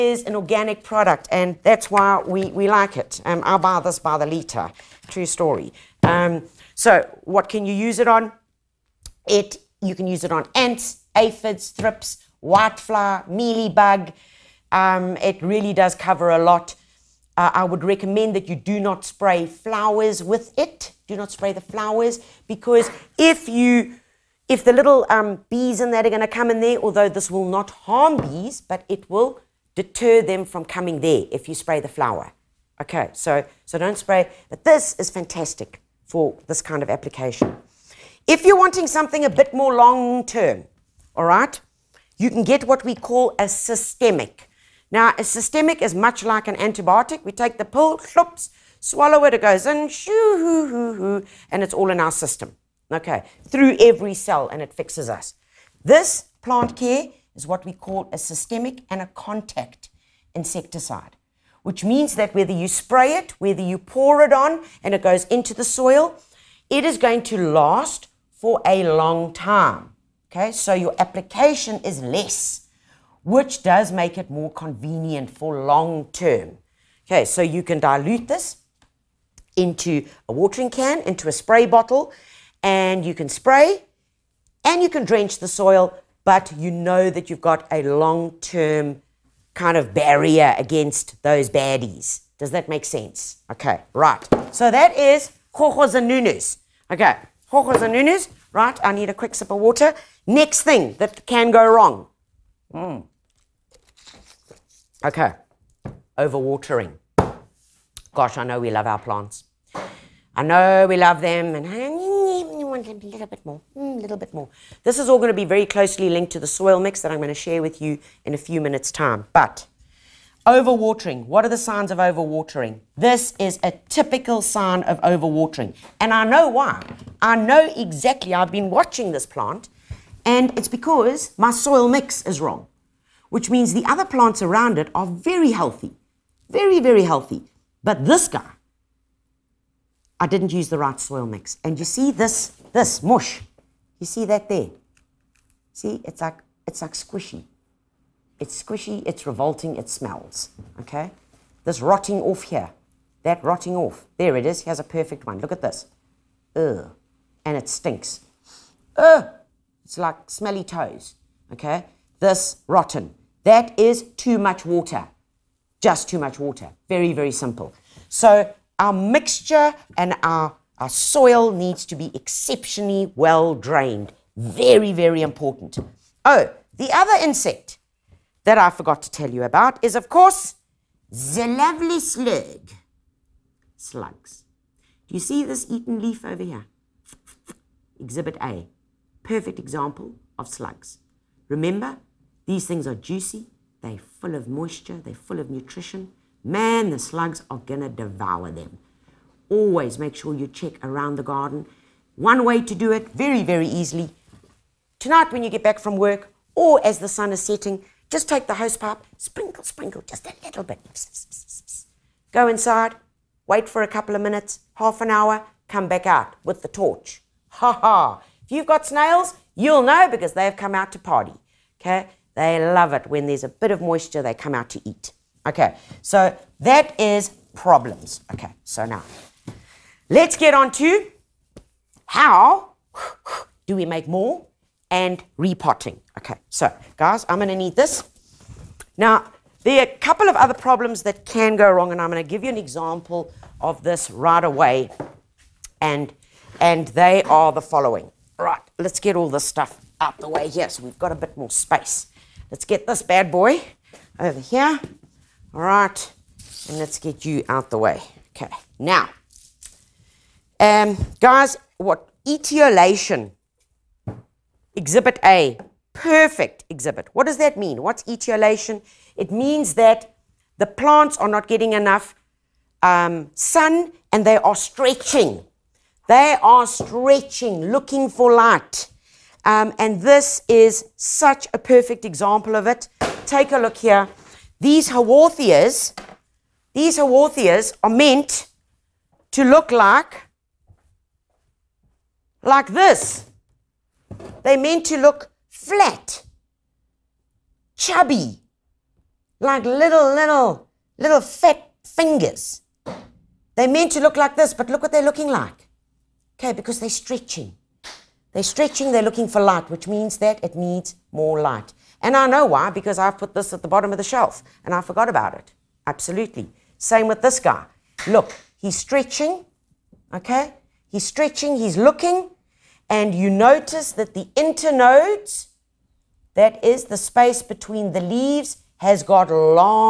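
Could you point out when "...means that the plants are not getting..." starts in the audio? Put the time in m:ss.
4:29.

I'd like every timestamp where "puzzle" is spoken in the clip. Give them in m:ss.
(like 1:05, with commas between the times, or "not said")
not said.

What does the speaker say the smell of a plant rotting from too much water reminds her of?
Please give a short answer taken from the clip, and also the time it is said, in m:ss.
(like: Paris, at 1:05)
smelly toes, at 2:40.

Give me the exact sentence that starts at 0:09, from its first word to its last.
It You can use it on ants, aphids, thrips, whitefly, mealybug.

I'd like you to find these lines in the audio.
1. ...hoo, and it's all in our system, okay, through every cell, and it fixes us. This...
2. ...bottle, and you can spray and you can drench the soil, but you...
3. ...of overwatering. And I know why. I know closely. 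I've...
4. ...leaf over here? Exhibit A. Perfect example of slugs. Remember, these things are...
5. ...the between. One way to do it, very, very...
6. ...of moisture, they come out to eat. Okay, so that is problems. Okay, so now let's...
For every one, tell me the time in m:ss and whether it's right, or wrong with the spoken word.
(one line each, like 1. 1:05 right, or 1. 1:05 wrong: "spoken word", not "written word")
1. 0:50 right
2. 1:21 right
3. 2:04 wrong: "exactly", not "closely"
4. 3:06 right
5. 3:21 wrong: "garden", not "between"
6. 3:43 right.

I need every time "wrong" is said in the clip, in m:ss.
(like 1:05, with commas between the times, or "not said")
1:41, 2:12, 4:01.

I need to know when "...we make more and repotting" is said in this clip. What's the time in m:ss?
3:53.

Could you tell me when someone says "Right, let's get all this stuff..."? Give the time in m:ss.
4:08.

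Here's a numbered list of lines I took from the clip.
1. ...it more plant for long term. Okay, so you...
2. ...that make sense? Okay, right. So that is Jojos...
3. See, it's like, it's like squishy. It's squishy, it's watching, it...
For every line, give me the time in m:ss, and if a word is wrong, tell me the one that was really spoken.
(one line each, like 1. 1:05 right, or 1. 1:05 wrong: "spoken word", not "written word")
1. 1:14 wrong: "convenient", not "plant"
2. 1:32 right
3. 2:25 wrong: "revolting", not "watching".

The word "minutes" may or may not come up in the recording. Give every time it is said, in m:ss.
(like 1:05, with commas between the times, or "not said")
1:58, 3:34.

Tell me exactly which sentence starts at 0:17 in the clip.
Uh, I would recommend that you do not spray flowers with it.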